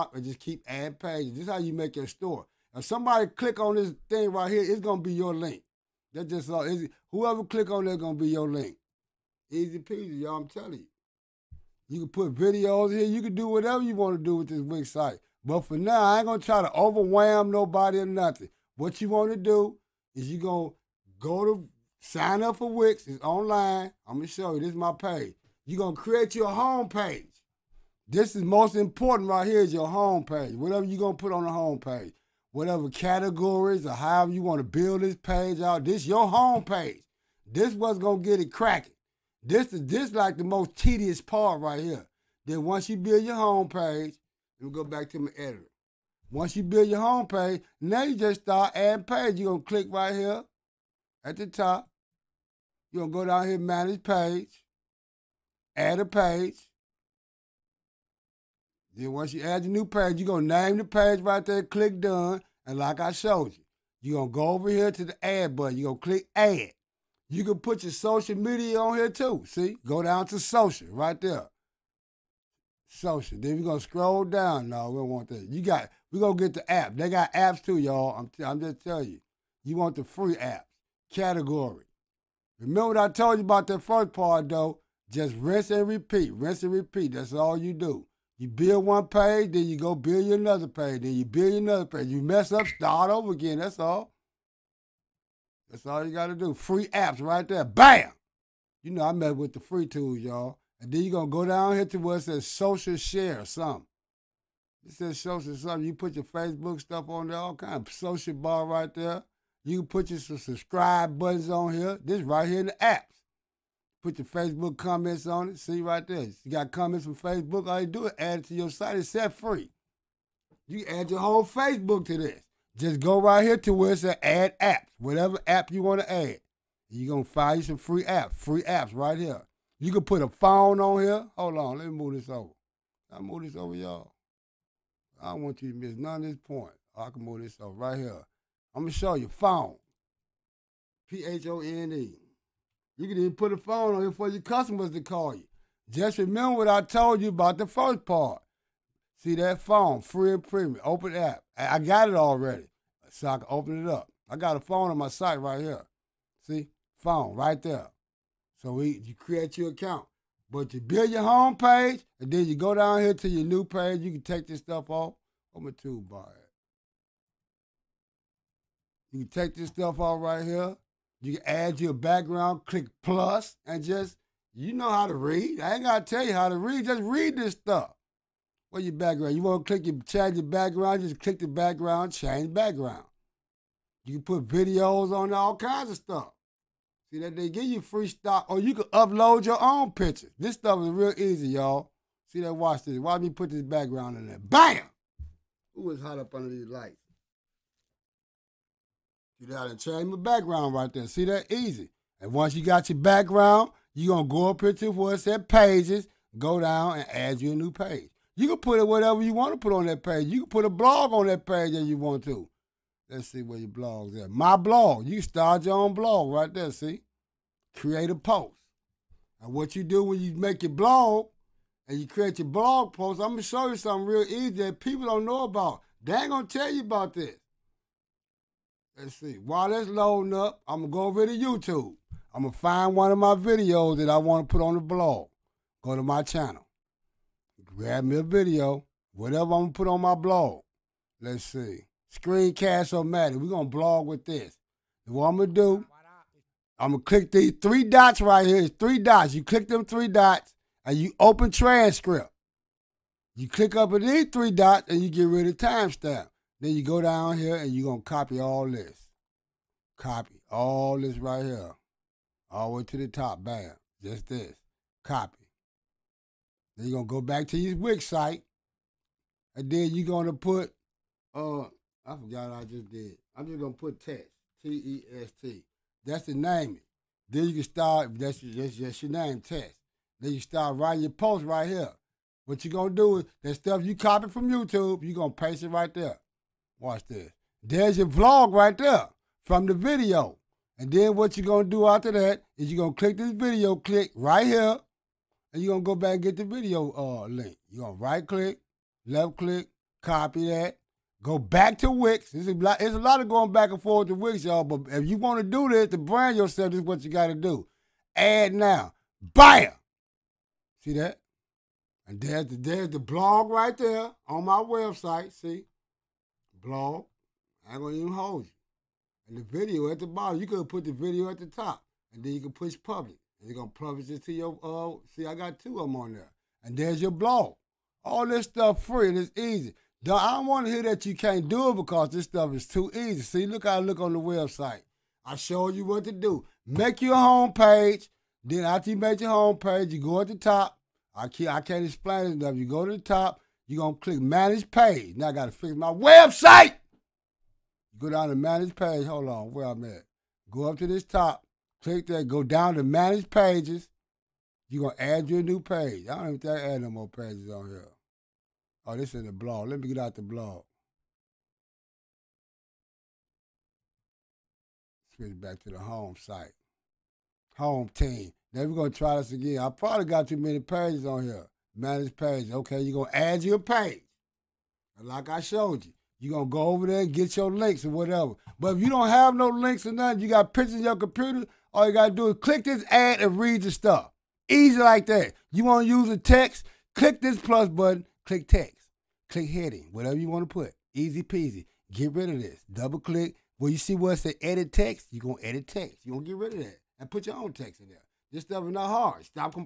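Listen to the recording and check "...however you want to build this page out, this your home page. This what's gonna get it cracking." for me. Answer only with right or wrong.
right.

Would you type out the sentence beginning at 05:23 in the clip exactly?
And you're gonna publish it to your uh see I got two of them on there.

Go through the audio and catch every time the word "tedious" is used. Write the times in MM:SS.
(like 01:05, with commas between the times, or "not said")
00:40.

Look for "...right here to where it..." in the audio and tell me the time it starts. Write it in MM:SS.
02:03.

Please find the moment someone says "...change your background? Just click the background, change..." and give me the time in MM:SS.
03:00.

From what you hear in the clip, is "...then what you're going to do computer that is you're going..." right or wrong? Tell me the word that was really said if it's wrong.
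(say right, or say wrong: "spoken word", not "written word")
wrong: "after", not "computer".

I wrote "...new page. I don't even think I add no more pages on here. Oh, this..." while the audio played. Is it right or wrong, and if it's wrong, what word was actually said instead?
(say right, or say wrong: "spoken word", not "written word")
right.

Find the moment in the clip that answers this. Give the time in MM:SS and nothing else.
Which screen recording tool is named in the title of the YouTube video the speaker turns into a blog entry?
04:02.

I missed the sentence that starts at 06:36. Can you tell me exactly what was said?
You're gonna get rid of that and put your own text in there.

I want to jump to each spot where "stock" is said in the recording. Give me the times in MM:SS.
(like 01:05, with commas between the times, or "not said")
03:08.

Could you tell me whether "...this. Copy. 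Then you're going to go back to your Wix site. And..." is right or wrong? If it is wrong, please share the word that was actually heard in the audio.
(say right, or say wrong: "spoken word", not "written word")
right.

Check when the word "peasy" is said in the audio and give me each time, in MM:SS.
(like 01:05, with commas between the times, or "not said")
00:09, 06:31.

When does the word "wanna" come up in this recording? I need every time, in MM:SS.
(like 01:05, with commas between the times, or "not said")
06:25, 06:30.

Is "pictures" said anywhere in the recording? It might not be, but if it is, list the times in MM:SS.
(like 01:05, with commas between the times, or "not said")
03:09, 06:20.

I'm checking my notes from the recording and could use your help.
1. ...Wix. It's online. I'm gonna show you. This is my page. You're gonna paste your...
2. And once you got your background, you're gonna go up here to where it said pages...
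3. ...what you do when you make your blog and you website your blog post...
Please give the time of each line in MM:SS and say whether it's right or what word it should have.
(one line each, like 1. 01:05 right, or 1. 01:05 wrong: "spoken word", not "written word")
1. 00:22 wrong: "create", not "paste"
2. 03:22 right
3. 03:39 wrong: "create", not "website".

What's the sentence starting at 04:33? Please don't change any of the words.
I'm just going to put text.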